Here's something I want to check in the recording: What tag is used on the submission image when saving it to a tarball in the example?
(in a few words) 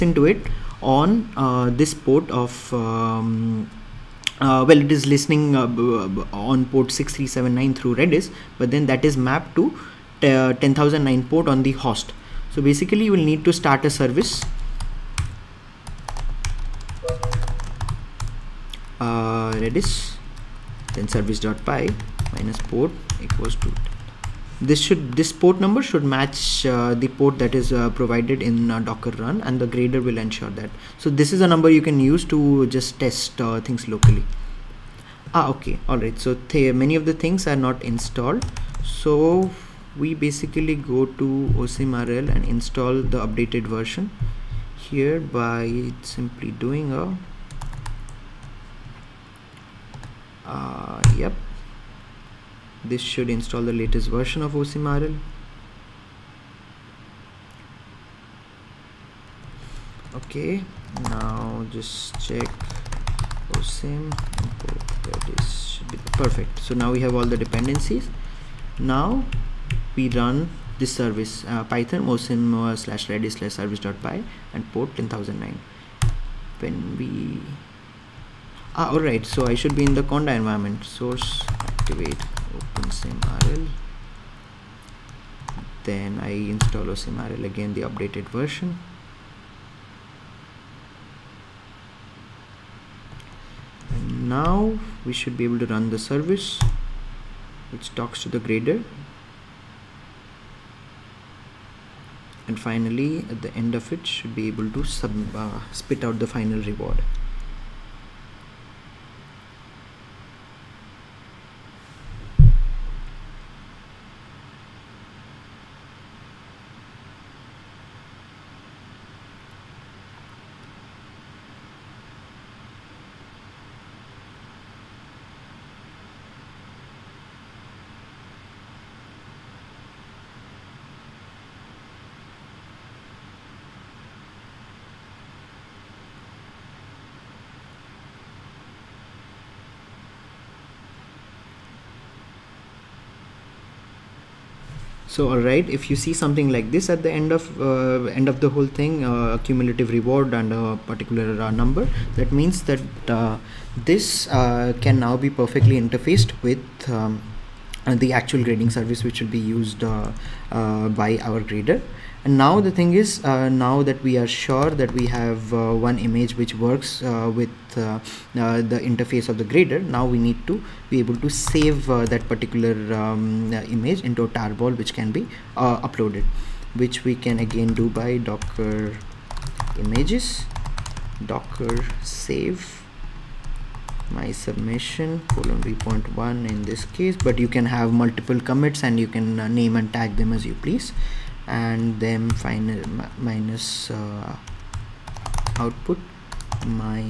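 v.1.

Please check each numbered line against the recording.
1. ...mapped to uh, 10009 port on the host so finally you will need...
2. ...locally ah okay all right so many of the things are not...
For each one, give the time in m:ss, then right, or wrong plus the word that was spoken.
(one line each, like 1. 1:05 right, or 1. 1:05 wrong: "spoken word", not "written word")
1. 0:09 wrong: "basically", not "finally"
2. 0:33 right.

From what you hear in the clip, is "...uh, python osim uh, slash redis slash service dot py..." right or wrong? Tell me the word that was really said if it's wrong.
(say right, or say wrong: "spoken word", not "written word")
right.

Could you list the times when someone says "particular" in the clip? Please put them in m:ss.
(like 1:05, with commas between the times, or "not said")
2:30, 2:52.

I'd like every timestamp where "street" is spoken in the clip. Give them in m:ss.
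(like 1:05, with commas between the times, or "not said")
not said.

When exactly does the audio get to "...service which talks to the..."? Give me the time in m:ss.
1:35.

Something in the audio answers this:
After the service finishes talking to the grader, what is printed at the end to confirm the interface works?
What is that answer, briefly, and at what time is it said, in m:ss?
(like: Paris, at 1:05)
cumulative reward, at 2:29.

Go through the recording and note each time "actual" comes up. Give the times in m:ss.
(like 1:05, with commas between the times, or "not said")
2:38.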